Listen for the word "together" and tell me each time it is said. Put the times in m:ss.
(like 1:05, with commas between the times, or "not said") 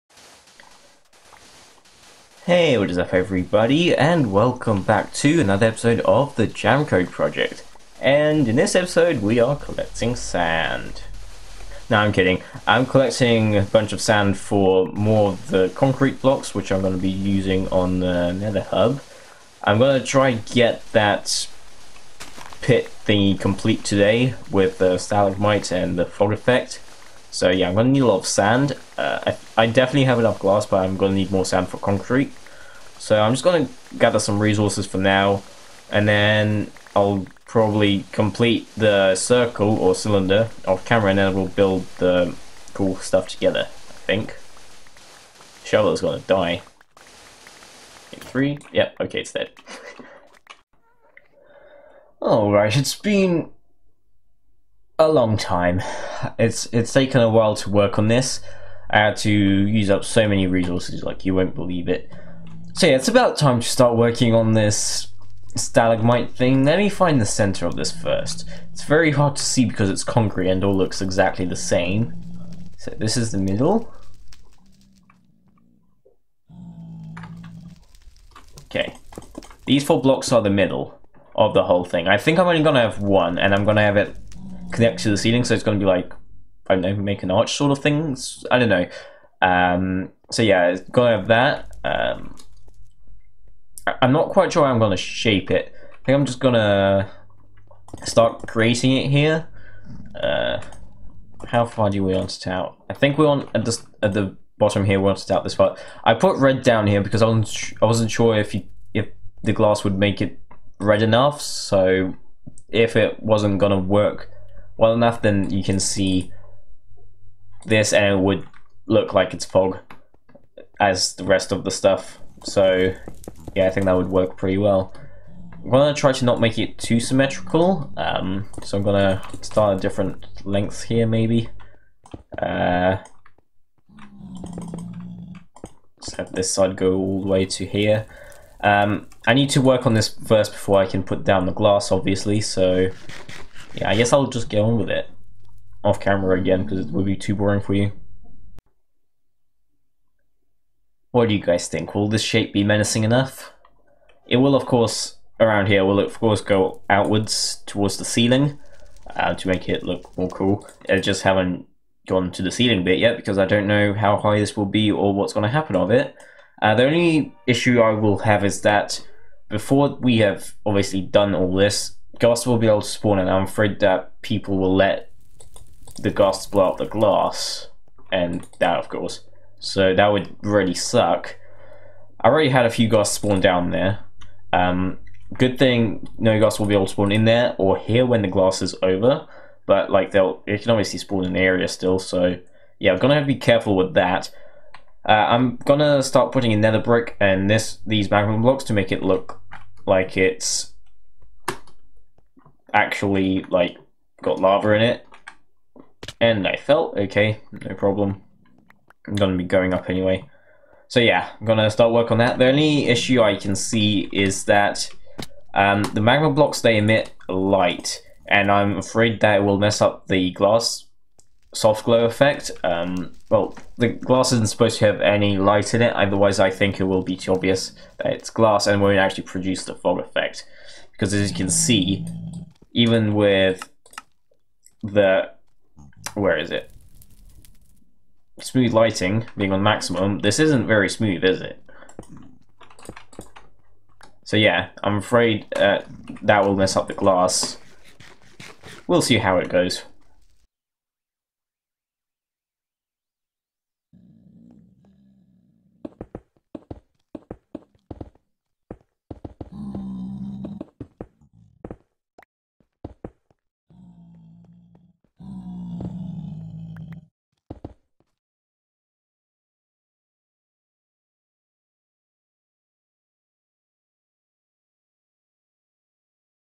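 0:43.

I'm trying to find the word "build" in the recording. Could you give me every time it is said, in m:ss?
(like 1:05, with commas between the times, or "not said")
0:41.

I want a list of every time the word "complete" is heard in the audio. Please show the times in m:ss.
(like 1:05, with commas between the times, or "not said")
0:23, 0:38.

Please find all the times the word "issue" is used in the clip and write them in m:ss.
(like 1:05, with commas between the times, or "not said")
2:47, 3:32.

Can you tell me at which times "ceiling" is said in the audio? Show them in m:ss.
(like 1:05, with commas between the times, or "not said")
1:25, 2:38, 2:42.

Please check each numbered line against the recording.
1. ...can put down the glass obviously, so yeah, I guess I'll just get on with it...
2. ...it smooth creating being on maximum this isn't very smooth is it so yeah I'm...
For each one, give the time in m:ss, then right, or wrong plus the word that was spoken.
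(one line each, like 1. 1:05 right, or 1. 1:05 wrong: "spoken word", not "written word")
1. 2:20 right
2. 3:56 wrong: "lighting", not "creating".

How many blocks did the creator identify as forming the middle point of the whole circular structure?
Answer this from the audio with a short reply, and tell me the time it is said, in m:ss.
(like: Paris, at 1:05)
4, at 1:19.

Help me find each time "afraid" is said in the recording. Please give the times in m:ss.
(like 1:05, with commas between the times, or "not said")
2:53, 3:38, 4:04.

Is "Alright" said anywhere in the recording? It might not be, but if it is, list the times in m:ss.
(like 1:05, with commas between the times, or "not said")
0:52.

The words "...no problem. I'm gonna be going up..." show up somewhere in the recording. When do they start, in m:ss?
3:27.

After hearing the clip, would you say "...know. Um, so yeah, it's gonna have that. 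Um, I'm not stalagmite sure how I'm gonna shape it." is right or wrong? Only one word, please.
wrong.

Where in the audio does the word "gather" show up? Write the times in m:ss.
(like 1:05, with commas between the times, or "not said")
0:33.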